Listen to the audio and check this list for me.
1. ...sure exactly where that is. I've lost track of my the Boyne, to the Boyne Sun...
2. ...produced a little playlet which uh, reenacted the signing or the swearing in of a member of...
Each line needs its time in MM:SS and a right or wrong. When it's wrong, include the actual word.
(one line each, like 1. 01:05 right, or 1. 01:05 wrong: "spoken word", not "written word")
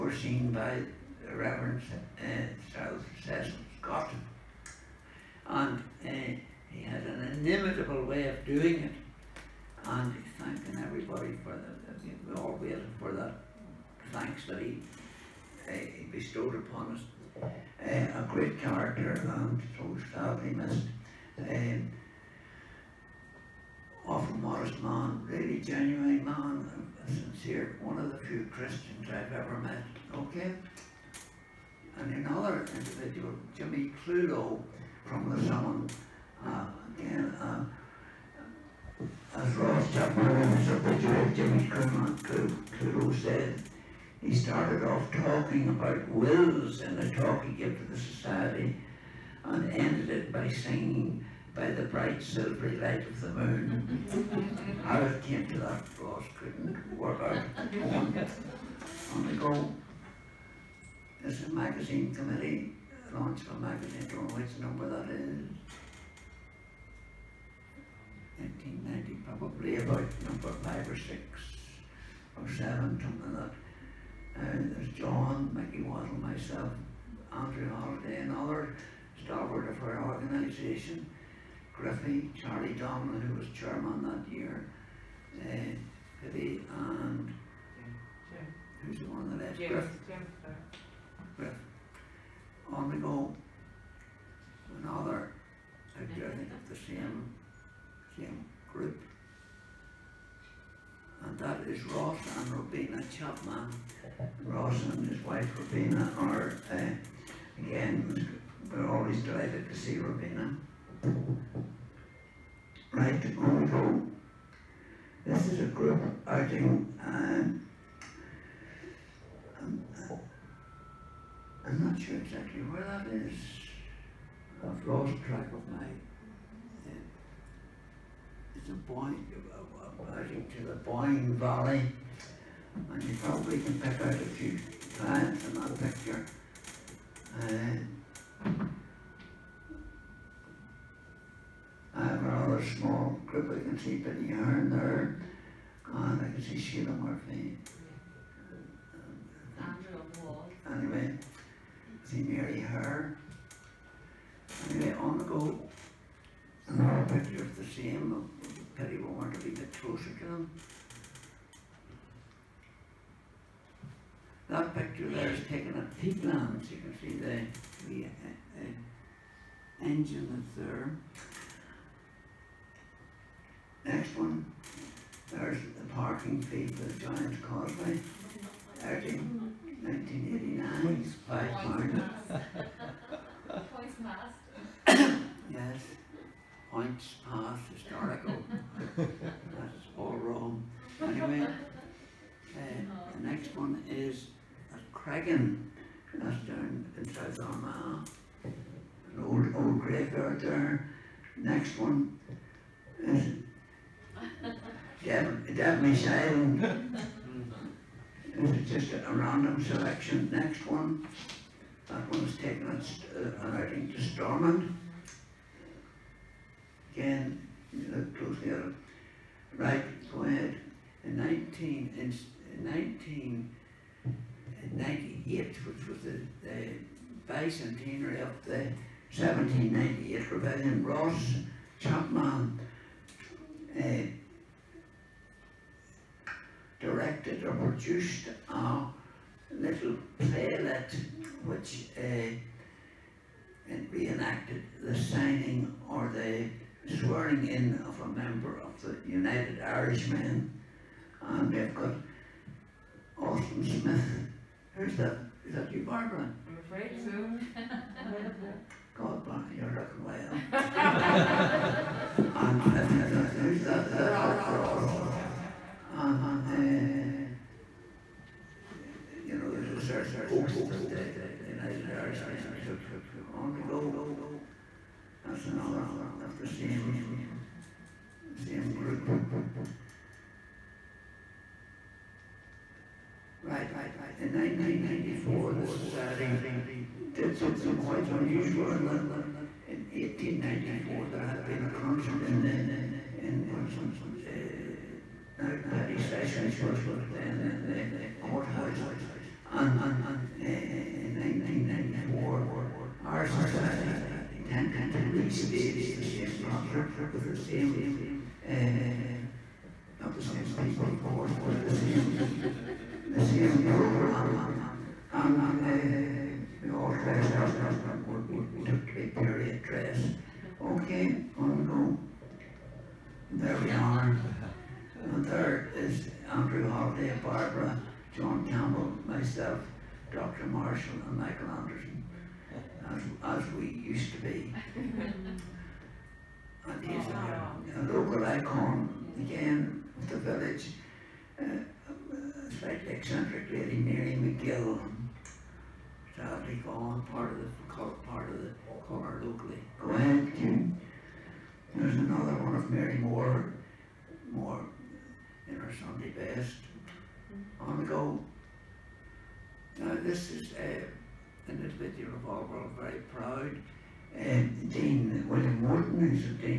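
1. 02:02 wrong: "Valley", not "Sun"
2. 03:57 right.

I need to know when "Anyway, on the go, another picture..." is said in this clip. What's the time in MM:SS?
02:34.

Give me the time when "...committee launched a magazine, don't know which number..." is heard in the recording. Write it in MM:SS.
01:02.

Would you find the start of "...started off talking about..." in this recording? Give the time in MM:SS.
00:44.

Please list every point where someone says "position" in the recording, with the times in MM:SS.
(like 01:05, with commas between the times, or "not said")
not said.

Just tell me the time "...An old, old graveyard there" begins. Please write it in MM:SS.
03:18.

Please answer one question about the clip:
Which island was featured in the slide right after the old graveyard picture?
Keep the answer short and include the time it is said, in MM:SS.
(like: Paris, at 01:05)
Devenish Island, at 03:25.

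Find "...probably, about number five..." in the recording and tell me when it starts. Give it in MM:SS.
01:09.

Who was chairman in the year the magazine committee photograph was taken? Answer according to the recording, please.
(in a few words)
Charlie Donnelly.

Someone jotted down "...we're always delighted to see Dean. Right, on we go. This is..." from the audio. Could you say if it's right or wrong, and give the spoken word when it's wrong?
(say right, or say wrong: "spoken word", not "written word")
wrong: "Robina", not "Dean".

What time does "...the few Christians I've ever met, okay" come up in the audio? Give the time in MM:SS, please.
00:28.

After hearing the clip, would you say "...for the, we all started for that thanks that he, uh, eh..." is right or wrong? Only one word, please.
wrong.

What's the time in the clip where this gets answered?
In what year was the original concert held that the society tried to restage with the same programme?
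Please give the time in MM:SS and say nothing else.
04:49.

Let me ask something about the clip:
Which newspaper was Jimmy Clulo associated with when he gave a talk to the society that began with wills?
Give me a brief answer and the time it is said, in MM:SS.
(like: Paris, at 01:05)
the Sun, at 00:35.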